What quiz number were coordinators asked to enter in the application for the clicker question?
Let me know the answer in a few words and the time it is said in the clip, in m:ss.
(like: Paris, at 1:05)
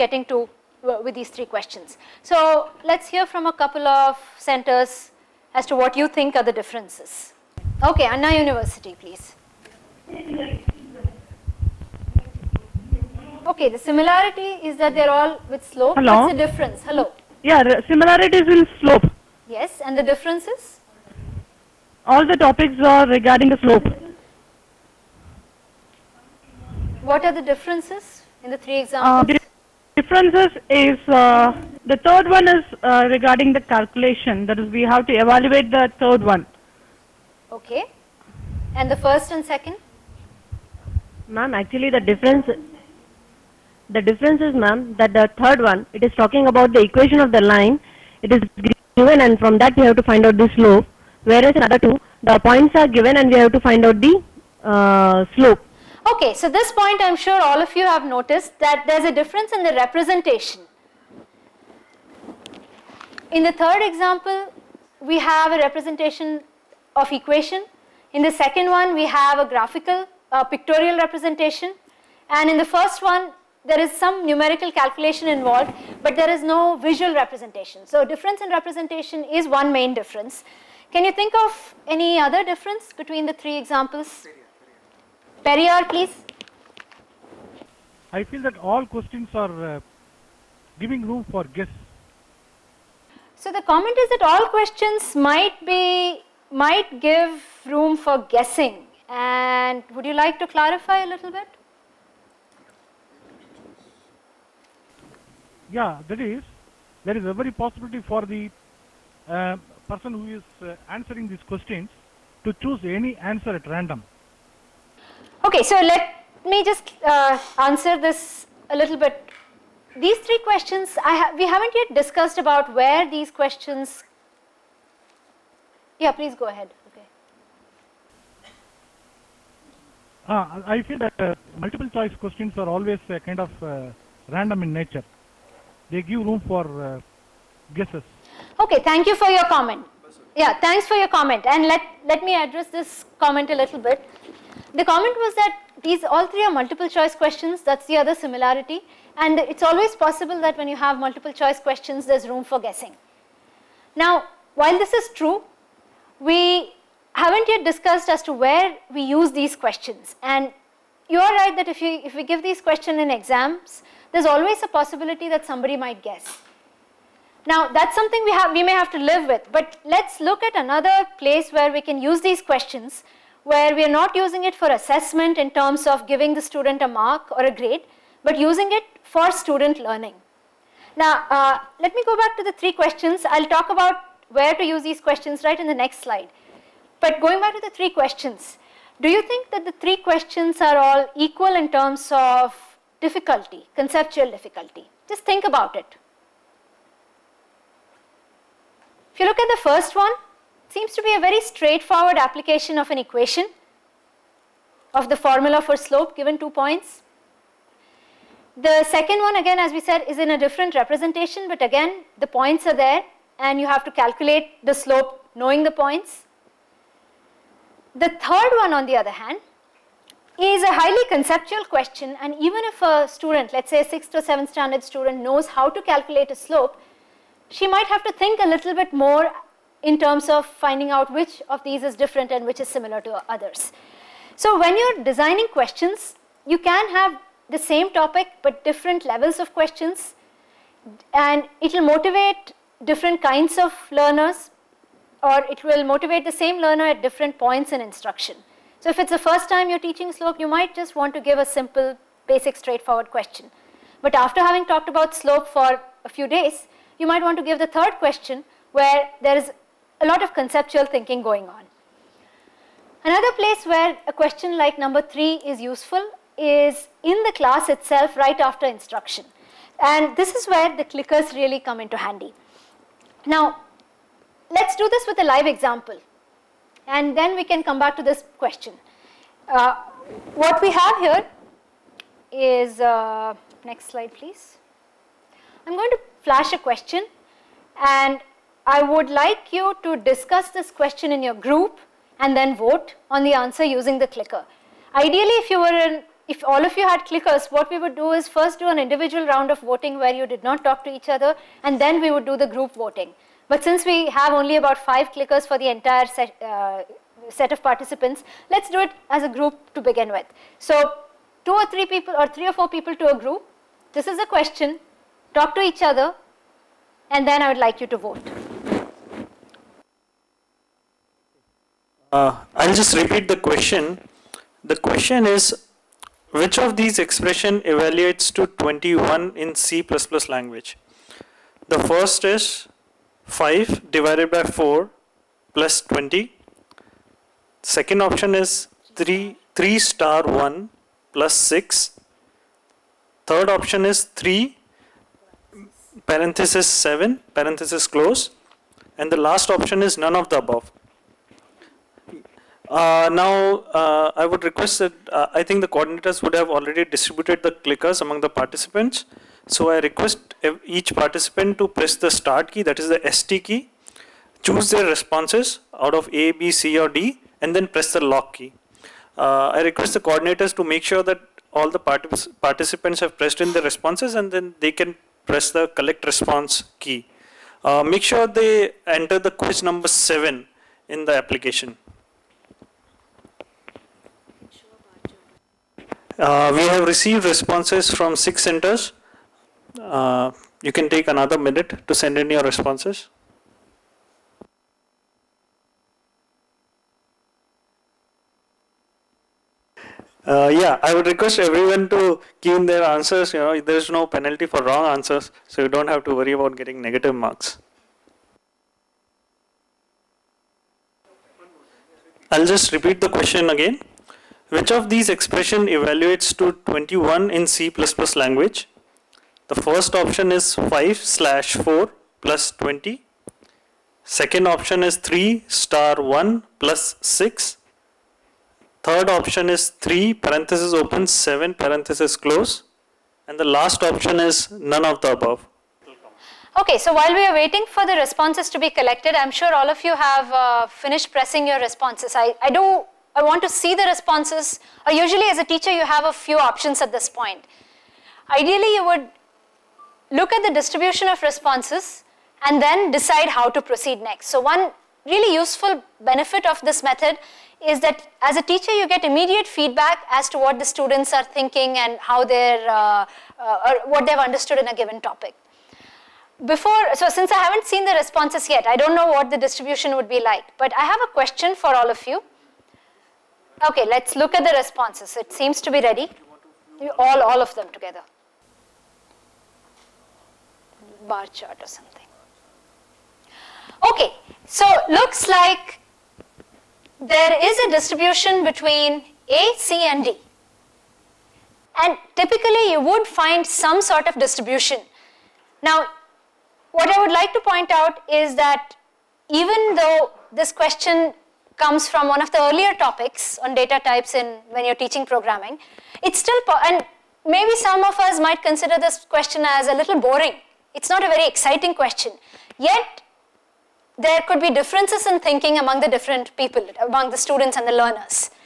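7, at 6:19.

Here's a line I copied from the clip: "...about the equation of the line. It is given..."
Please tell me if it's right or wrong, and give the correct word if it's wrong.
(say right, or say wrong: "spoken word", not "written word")
right.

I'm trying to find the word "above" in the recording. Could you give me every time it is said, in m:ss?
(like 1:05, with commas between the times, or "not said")
5:50, 7:15.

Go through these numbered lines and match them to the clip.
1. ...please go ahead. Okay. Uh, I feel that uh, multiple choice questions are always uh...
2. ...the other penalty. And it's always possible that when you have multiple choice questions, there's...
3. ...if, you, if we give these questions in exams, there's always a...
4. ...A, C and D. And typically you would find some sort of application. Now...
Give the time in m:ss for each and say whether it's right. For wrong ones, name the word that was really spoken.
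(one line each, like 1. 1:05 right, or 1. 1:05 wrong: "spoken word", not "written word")
1. 2:06 right
2. 2:27 wrong: "similarity", not "penalty"
3. 2:41 right
4. 8:09 wrong: "distribution", not "application".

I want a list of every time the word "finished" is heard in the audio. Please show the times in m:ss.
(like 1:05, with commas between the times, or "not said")
7:20.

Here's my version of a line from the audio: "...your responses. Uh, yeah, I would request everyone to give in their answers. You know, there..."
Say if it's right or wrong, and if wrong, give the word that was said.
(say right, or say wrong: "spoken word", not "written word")
right.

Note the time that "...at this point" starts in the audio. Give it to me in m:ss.
7:26.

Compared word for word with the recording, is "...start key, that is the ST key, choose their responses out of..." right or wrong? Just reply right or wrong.
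right.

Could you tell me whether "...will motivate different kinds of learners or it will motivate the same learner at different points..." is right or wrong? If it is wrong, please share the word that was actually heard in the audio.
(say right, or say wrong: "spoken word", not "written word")
right.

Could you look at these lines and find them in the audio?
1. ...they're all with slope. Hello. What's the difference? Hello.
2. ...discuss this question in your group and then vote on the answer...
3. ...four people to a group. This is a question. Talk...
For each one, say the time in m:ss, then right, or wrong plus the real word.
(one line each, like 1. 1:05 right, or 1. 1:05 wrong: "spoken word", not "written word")
1. 0:14 right
2. 4:49 right
3. 5:12 right.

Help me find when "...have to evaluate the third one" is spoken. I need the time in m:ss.
0:34.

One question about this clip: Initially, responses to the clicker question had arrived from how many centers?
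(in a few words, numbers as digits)
6.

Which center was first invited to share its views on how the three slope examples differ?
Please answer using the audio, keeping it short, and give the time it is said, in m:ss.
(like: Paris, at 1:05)
Anna University, at 0:08.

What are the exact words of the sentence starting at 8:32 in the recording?
Yet, there could be differences in thinking among the different people, among the students and the learners.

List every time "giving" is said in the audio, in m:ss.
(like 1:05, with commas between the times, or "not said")
1:30, 2:56.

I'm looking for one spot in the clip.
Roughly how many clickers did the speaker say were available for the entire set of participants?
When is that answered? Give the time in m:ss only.
5:04.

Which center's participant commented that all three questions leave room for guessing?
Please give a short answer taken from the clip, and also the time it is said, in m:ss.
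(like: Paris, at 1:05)
Periyar, at 1:25.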